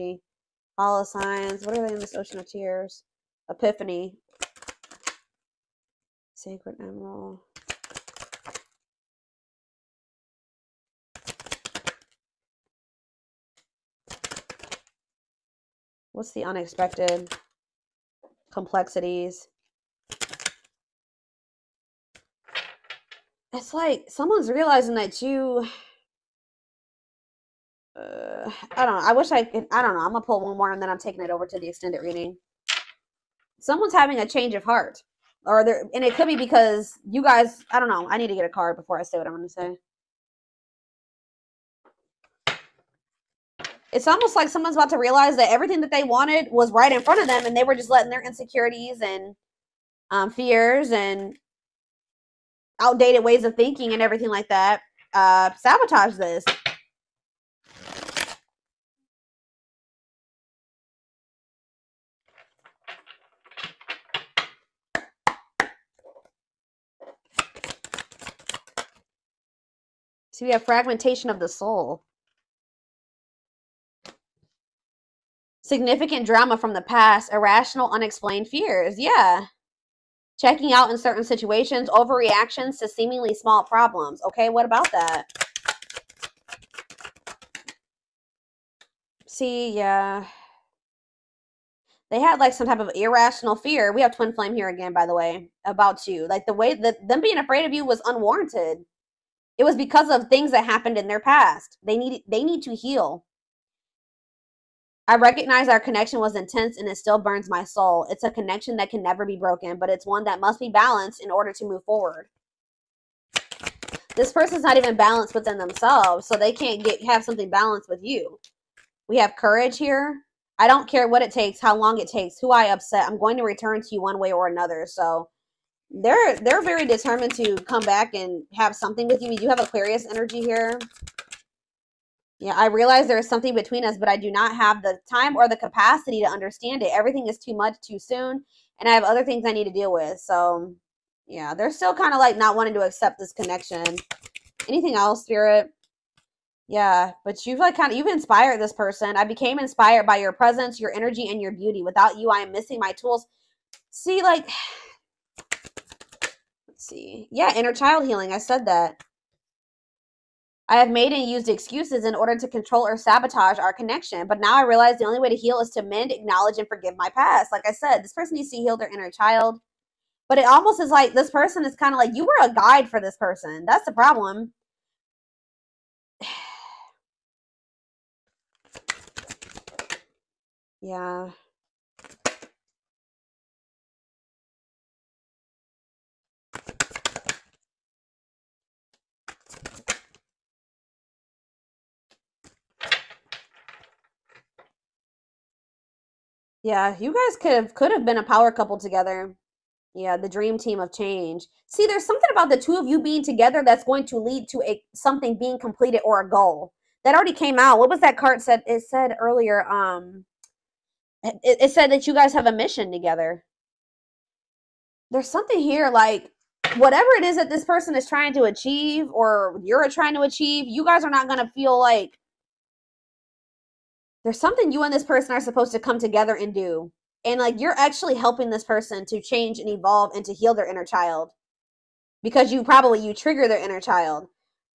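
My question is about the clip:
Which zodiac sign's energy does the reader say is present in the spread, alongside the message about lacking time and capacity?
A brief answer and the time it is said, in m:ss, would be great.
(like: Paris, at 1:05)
Aquarius, at 2:09.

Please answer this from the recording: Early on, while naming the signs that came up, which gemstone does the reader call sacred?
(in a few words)
emerald.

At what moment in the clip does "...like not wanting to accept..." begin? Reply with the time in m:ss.
2:22.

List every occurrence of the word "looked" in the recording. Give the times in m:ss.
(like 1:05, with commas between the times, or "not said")
not said.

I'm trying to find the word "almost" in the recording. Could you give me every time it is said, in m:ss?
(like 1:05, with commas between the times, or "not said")
0:44, 2:50.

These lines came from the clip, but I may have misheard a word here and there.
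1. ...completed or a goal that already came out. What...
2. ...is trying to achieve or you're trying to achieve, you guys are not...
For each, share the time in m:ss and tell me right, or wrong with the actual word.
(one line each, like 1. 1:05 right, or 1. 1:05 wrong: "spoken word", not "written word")
1. 3:25 right
2. 3:37 right.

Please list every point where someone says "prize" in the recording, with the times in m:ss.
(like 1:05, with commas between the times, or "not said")
not said.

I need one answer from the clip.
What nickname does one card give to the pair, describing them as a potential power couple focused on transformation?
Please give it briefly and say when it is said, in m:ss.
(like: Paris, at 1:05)
the dream team of change, at 3:20.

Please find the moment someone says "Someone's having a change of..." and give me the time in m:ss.
0:33.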